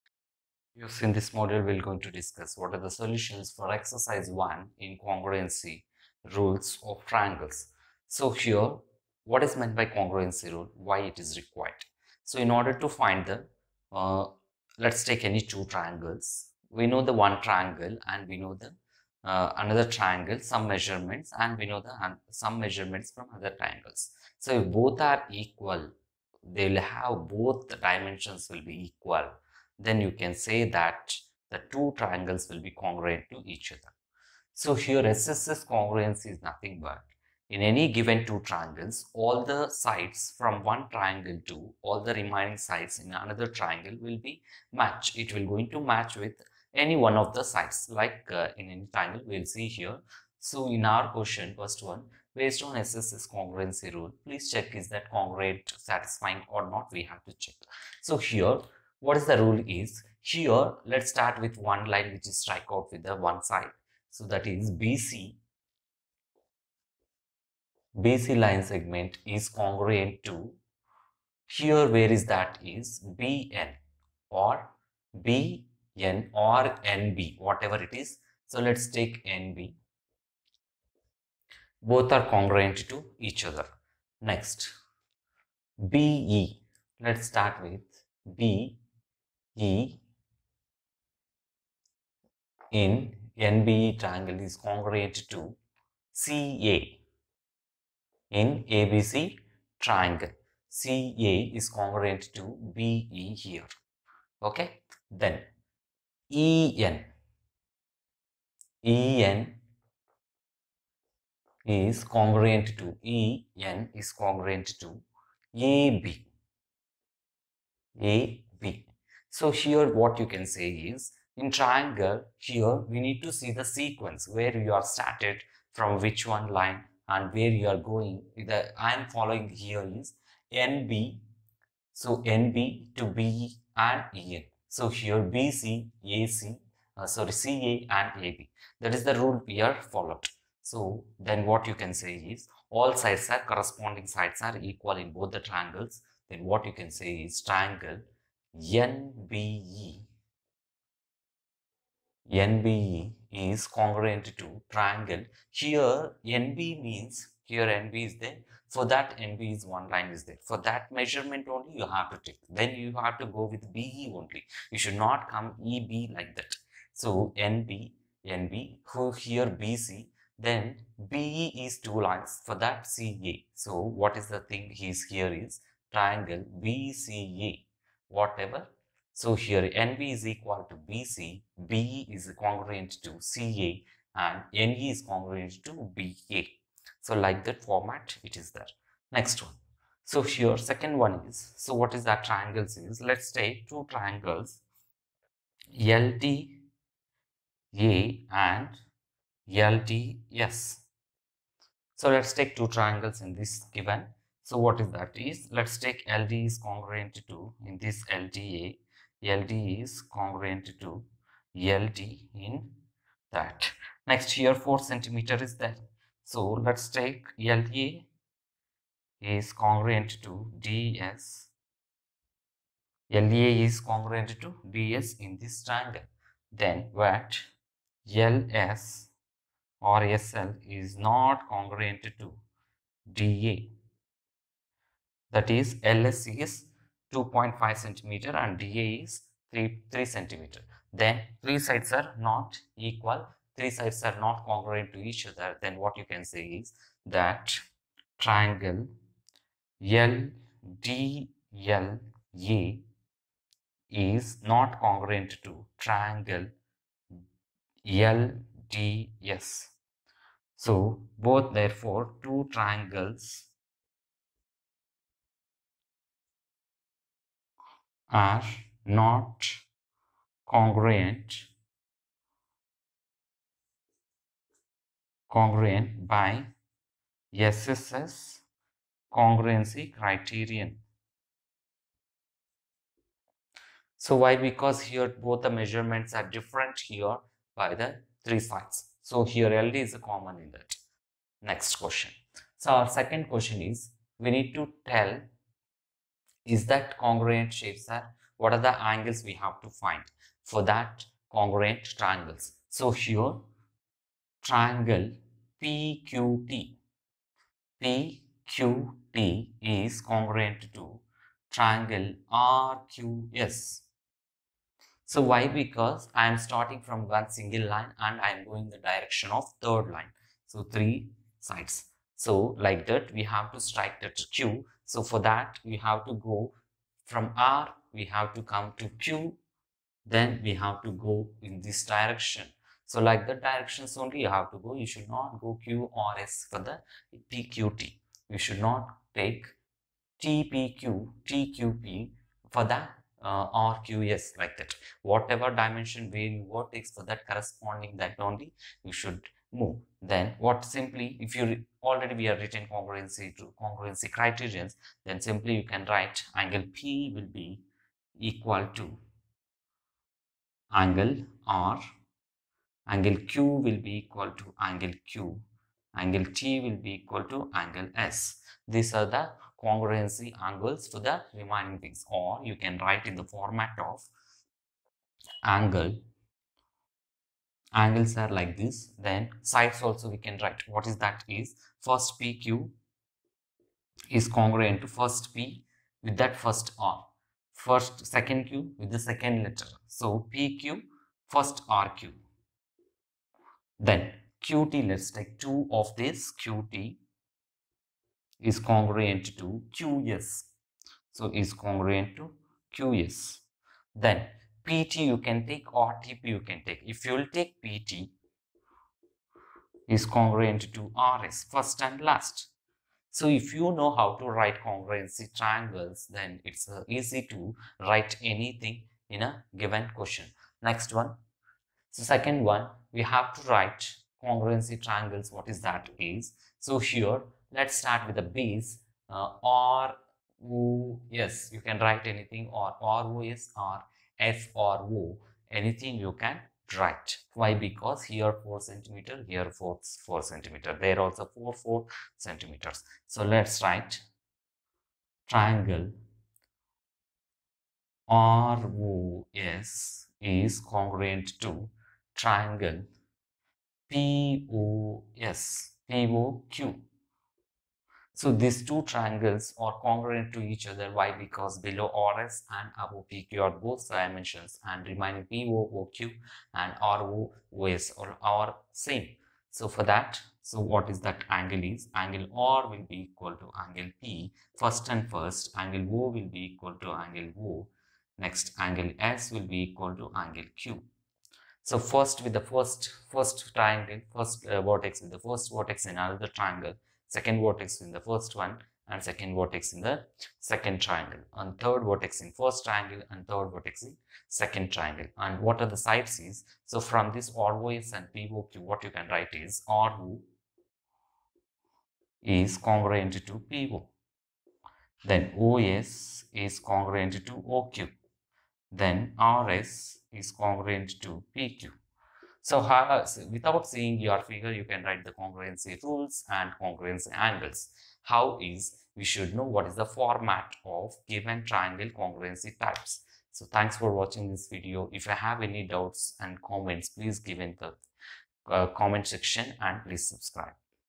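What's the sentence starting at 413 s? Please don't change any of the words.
So if you know how to write congruency triangles then it's uh, easy to write anything in a given question.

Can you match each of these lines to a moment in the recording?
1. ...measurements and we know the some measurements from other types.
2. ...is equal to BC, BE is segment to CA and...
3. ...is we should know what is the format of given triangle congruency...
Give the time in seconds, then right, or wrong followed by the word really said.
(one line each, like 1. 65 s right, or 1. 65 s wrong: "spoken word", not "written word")
1. 20 s wrong: "triangles", not "types"
2. 180 s wrong: "congruent", not "segment"
3. 518 s right.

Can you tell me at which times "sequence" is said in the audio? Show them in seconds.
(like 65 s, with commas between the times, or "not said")
123 s.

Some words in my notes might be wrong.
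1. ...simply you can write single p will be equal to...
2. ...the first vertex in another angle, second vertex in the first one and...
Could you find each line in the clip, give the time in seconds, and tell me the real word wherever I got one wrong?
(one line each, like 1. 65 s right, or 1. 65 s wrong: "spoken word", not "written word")
1. 355 s wrong: "angle", not "single"
2. 485 s wrong: "triangle", not "angle".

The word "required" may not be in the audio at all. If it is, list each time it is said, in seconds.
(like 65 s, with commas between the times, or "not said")
11 s.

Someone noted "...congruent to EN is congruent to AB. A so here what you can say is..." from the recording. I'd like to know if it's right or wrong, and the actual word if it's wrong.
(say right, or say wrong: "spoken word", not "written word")
right.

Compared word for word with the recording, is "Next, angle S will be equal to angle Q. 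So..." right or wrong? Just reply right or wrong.
right.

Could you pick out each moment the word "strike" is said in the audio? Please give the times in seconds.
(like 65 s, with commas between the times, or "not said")
62 s, 323 s.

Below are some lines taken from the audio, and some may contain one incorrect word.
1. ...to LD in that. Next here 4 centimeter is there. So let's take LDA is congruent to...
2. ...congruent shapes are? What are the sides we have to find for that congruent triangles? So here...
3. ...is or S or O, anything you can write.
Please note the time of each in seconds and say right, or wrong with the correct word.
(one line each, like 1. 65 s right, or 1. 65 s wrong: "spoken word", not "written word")
1. 210 s right
2. 296 s wrong: "angles", not "sides"
3. 433 s right.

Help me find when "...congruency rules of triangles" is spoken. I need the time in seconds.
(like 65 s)
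5 s.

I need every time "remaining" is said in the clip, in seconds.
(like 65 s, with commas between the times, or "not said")
42 s, 371 s, 464 s.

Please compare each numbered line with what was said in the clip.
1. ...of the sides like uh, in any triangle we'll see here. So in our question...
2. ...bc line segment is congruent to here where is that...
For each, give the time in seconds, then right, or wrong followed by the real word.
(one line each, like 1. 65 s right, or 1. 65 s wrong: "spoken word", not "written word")
1. 47 s right
2. 68 s right.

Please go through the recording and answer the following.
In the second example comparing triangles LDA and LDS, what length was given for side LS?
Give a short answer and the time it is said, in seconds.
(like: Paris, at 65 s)
2.5 centimeters, at 237 s.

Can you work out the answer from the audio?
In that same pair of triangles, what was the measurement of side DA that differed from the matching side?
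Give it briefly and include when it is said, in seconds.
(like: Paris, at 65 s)
3 centimeters, at 239 s.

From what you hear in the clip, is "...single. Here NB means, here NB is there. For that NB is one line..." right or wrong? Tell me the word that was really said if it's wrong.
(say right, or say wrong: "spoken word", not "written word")
wrong: "triangle", not "single".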